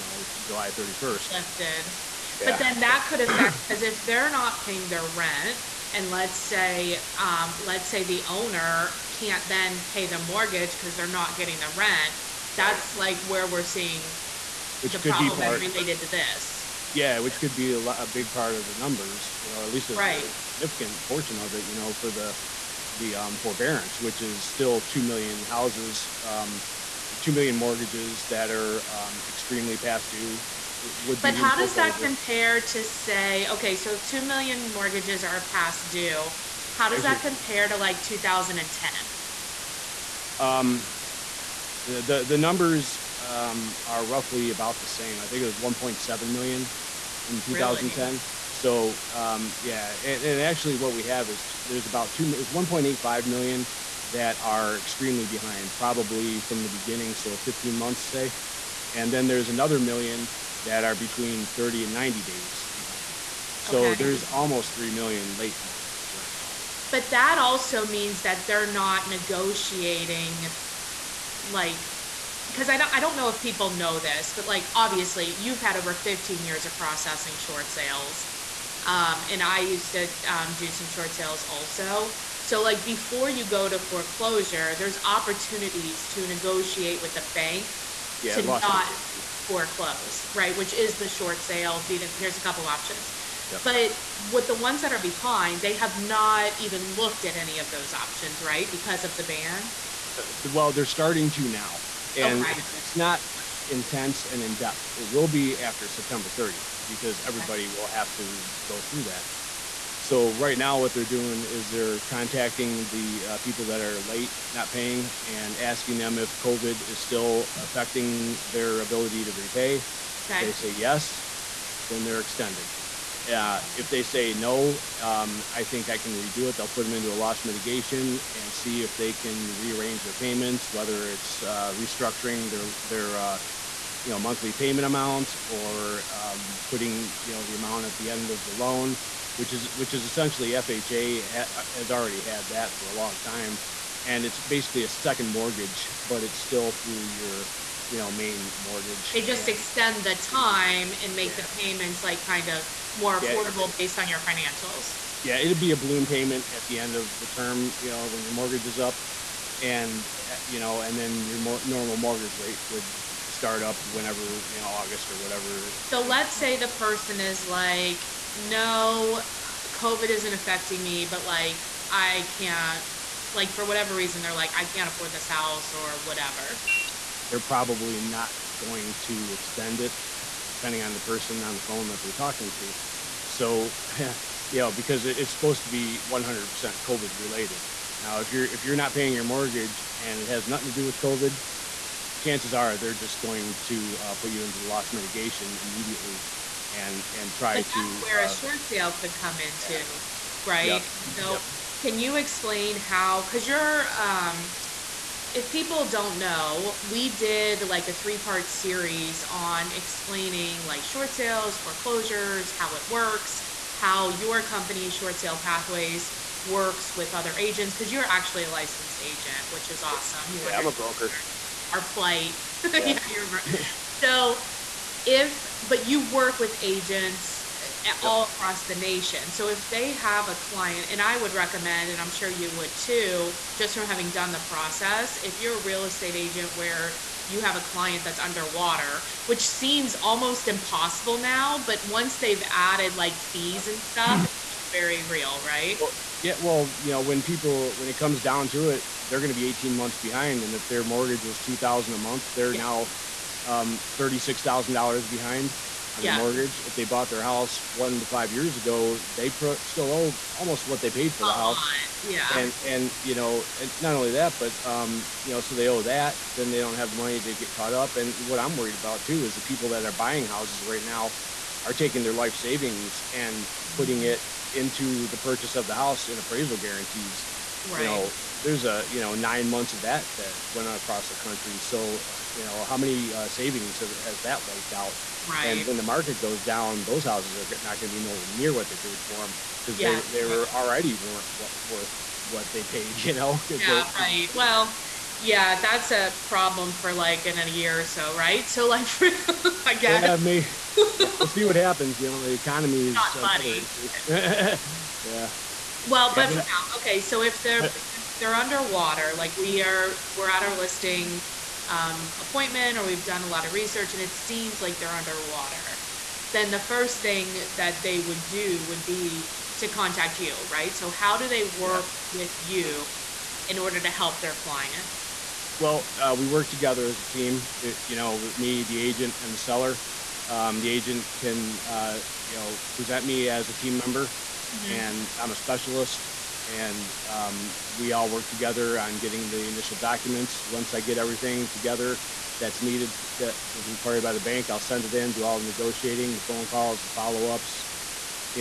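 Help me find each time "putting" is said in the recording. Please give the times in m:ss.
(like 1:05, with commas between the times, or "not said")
2:16, 4:33.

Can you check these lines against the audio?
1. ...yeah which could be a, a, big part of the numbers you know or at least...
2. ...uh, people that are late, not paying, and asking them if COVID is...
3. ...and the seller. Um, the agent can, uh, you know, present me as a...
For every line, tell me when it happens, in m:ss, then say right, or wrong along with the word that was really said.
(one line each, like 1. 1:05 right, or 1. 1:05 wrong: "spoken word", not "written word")
1. 0:16 right
2. 1:53 right
3. 5:29 right.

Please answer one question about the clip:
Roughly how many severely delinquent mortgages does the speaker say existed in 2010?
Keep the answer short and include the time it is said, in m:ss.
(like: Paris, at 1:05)
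1.7 million, at 0:45.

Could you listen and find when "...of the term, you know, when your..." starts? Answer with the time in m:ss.
2:36.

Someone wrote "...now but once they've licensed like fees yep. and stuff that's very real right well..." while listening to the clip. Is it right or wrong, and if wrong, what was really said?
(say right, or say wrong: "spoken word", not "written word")
wrong: "added", not "licensed".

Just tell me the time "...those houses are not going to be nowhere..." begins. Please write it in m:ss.
4:46.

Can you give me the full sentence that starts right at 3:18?
where uh, a short sale could come into, yeah.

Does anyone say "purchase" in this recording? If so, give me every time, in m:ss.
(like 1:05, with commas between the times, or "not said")
4:35.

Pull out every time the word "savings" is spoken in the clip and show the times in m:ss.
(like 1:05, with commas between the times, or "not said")
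4:32, 4:43.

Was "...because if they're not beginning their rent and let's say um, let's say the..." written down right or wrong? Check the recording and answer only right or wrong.
wrong.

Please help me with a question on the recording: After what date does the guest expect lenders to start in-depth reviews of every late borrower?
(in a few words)
September 30th.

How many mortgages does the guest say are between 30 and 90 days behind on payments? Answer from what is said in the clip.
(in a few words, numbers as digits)
1 million.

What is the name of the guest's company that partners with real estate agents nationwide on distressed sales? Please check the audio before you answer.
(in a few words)
Short Sale Pathways.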